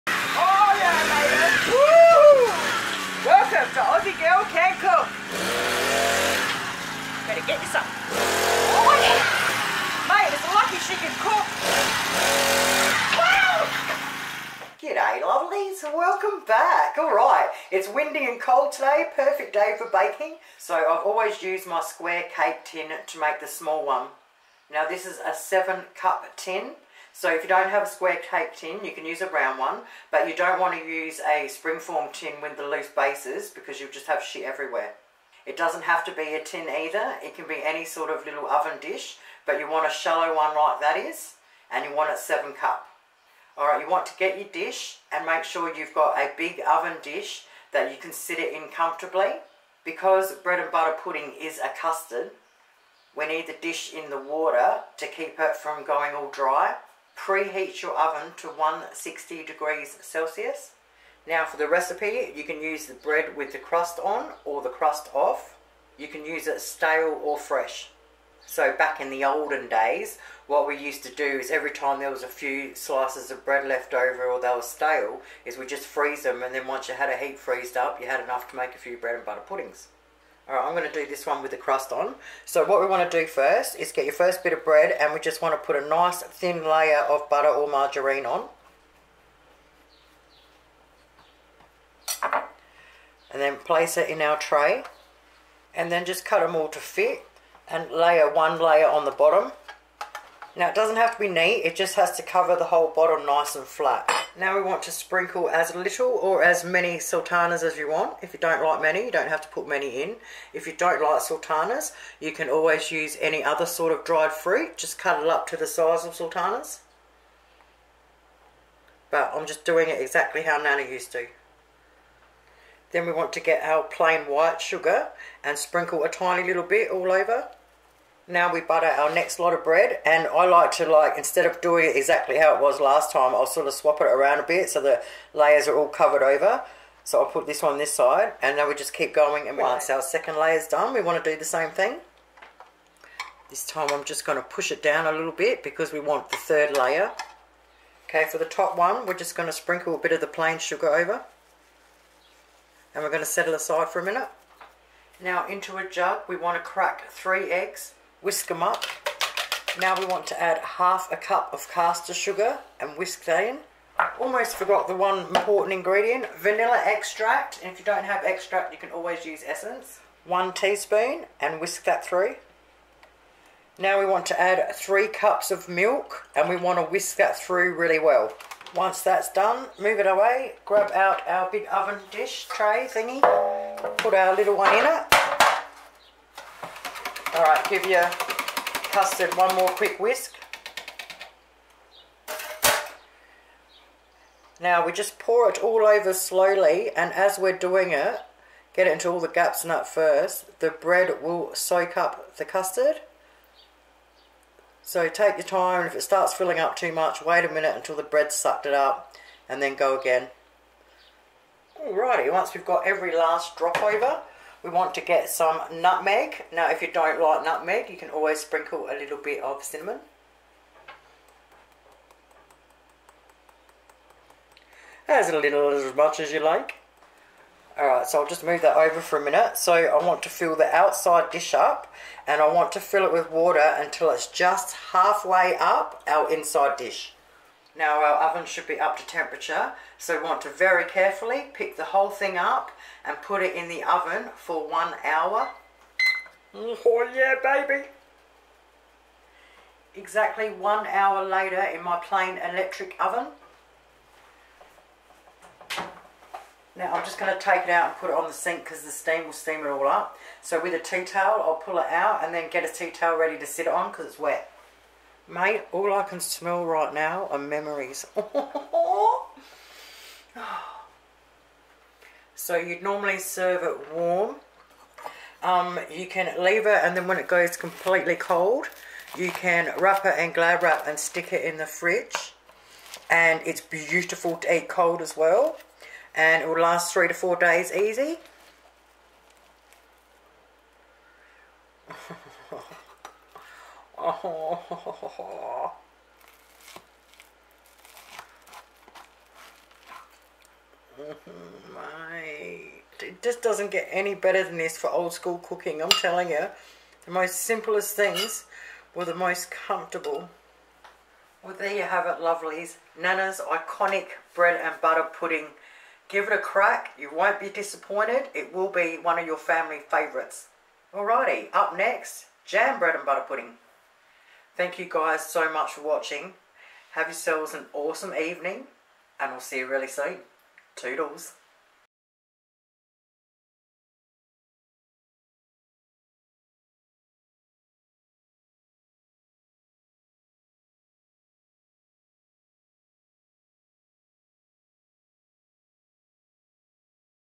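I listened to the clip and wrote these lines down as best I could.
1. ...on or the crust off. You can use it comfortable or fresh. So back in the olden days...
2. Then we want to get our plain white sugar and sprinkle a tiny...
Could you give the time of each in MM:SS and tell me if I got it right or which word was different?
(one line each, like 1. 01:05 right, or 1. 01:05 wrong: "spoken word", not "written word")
1. 01:04 wrong: "stale", not "comfortable"
2. 02:02 right.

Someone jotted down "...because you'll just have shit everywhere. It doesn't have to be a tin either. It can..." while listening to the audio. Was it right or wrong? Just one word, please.
right.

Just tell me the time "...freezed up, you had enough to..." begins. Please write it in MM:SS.
01:17.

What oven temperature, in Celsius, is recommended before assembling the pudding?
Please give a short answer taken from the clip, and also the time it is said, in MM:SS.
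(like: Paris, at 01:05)
160 degrees, at 00:58.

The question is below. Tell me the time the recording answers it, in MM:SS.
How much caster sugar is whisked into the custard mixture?
02:40.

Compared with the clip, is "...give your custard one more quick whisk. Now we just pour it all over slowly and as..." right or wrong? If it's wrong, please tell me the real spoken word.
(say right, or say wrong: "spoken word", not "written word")
right.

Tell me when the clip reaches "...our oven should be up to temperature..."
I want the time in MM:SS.
03:58.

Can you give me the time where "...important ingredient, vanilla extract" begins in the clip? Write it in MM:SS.
02:45.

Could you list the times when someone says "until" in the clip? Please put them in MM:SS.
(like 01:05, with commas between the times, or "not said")
03:27, 03:53.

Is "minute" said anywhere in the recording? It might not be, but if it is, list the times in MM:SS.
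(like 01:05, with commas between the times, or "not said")
02:34, 03:27, 03:49.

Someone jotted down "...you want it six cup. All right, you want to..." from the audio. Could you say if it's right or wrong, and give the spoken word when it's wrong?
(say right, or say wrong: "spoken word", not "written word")
wrong: "seven", not "six".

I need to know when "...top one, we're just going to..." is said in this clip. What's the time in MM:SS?
02:28.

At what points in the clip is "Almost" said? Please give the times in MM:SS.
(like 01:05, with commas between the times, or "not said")
02:44.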